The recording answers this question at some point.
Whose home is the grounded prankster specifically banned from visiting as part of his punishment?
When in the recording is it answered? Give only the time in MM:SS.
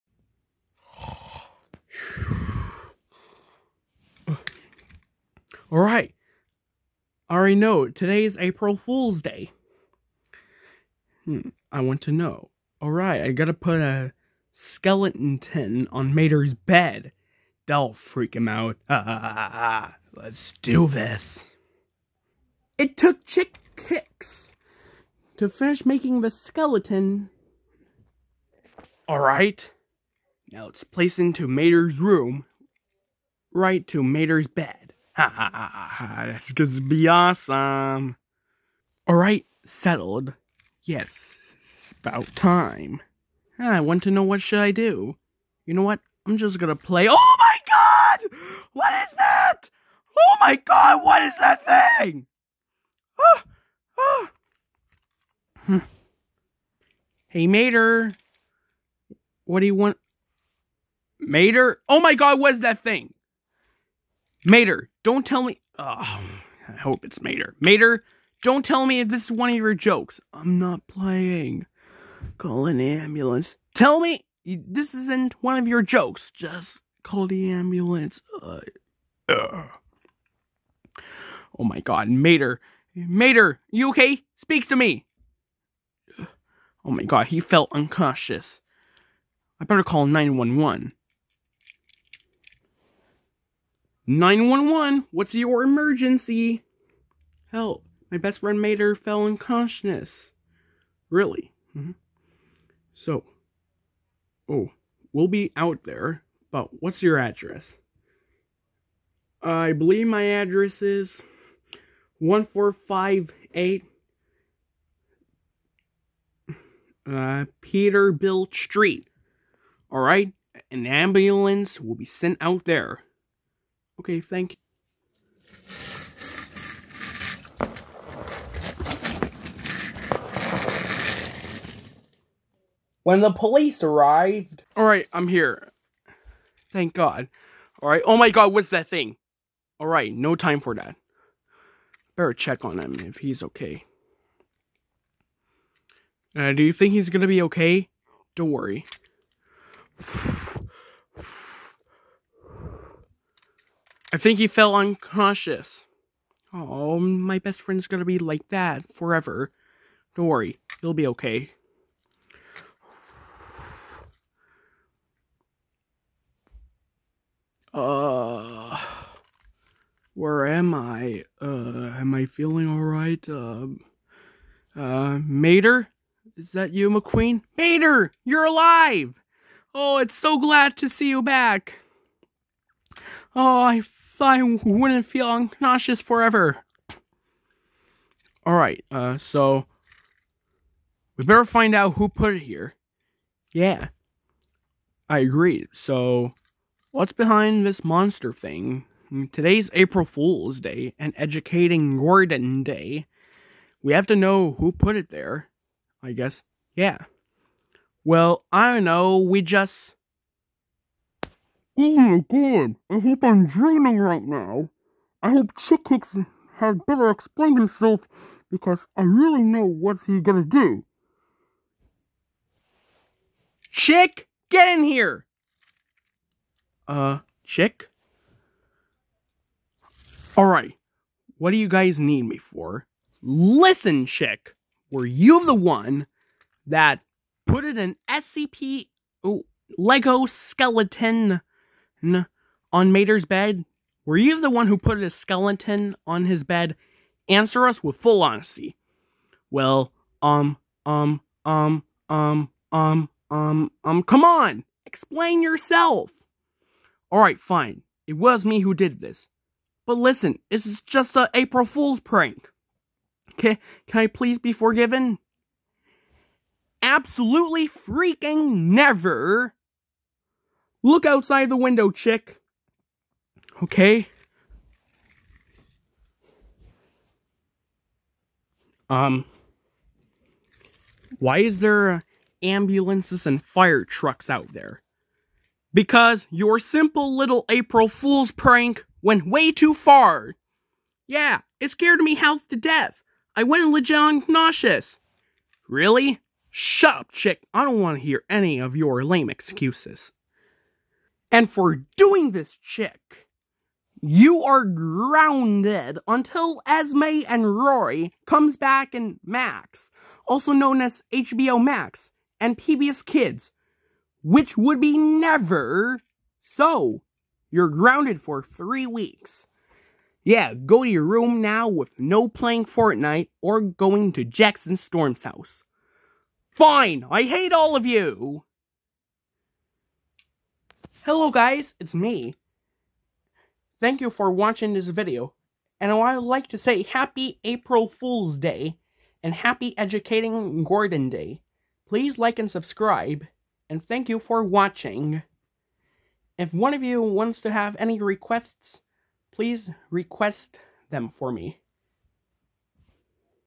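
05:24.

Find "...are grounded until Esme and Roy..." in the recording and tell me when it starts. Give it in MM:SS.
05:04.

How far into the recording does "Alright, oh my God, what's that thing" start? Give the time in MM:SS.
02:17.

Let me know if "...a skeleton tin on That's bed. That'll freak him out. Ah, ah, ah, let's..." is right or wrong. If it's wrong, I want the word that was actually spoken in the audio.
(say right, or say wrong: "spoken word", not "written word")
wrong: "Mater", not "That".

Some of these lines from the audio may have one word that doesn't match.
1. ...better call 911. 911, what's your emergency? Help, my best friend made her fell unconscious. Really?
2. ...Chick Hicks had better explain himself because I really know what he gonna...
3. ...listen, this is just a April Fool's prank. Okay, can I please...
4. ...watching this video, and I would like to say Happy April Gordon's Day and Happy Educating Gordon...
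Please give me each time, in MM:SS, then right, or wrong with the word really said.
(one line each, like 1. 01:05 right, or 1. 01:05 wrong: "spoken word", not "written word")
1. 01:29 right
2. 03:35 right
3. 04:19 right
4. 05:34 wrong: "Fool", not "Gordon".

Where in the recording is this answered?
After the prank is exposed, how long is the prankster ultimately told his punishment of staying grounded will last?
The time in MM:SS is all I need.
05:18.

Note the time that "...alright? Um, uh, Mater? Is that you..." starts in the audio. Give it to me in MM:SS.
02:52.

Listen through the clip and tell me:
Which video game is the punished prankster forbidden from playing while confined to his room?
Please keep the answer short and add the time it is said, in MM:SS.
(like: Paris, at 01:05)
Fortnite, at 05:22.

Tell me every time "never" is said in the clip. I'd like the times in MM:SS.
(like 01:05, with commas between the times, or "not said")
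04:28, 05:14.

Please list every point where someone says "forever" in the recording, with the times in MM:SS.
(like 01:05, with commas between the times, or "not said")
02:38, 03:06.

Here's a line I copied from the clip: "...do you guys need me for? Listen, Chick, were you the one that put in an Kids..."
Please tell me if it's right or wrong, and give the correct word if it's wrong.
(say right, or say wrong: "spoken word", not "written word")
wrong: "SCP", not "Kids".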